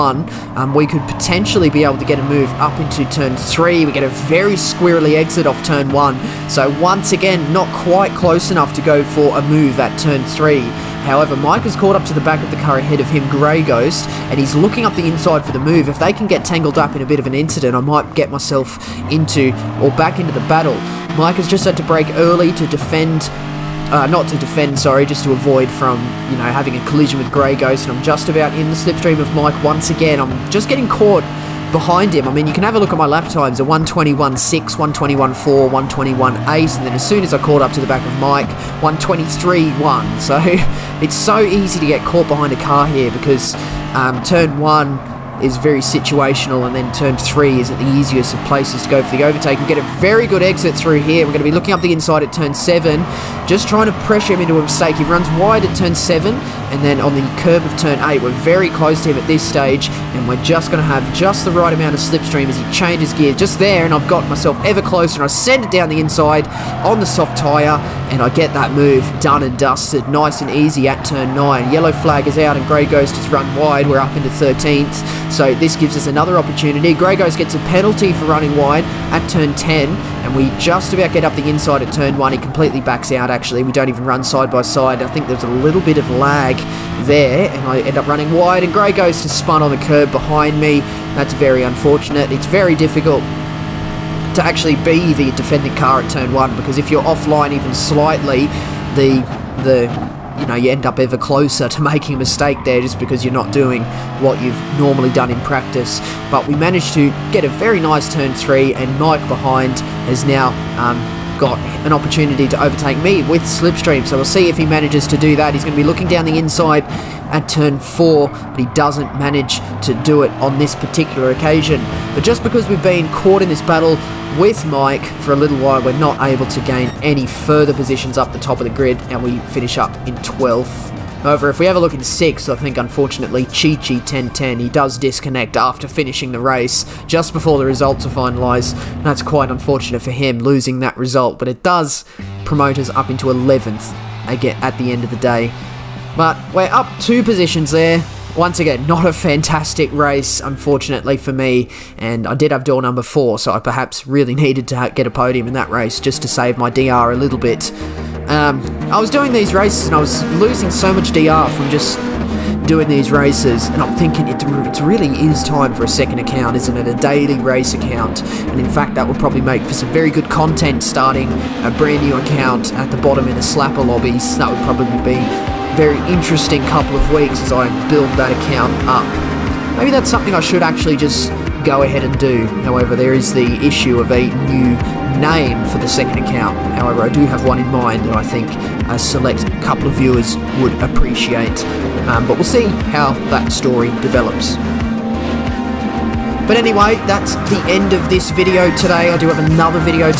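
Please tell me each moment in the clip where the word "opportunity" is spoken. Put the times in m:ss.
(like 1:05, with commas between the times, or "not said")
1:16, 1:51.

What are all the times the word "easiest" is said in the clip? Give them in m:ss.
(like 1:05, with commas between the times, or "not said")
0:47.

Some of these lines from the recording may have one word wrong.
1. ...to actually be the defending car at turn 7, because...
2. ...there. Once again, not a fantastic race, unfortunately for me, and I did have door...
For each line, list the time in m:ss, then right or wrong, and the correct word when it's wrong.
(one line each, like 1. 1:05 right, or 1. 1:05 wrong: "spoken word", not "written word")
1. 1:34 wrong: "1", not "7"
2. 2:27 right.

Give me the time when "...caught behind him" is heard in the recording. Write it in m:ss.
0:30.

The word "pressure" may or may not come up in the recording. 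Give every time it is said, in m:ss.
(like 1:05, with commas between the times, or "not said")
0:54.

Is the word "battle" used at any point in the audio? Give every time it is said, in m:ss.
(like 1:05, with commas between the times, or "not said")
0:20, 2:03.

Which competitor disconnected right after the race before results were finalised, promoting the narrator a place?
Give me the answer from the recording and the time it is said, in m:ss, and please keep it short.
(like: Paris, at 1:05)
Chi-Chi 1010, at 2:13.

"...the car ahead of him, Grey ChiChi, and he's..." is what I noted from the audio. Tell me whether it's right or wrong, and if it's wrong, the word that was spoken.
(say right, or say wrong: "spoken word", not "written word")
wrong: "Ghost", not "ChiChi".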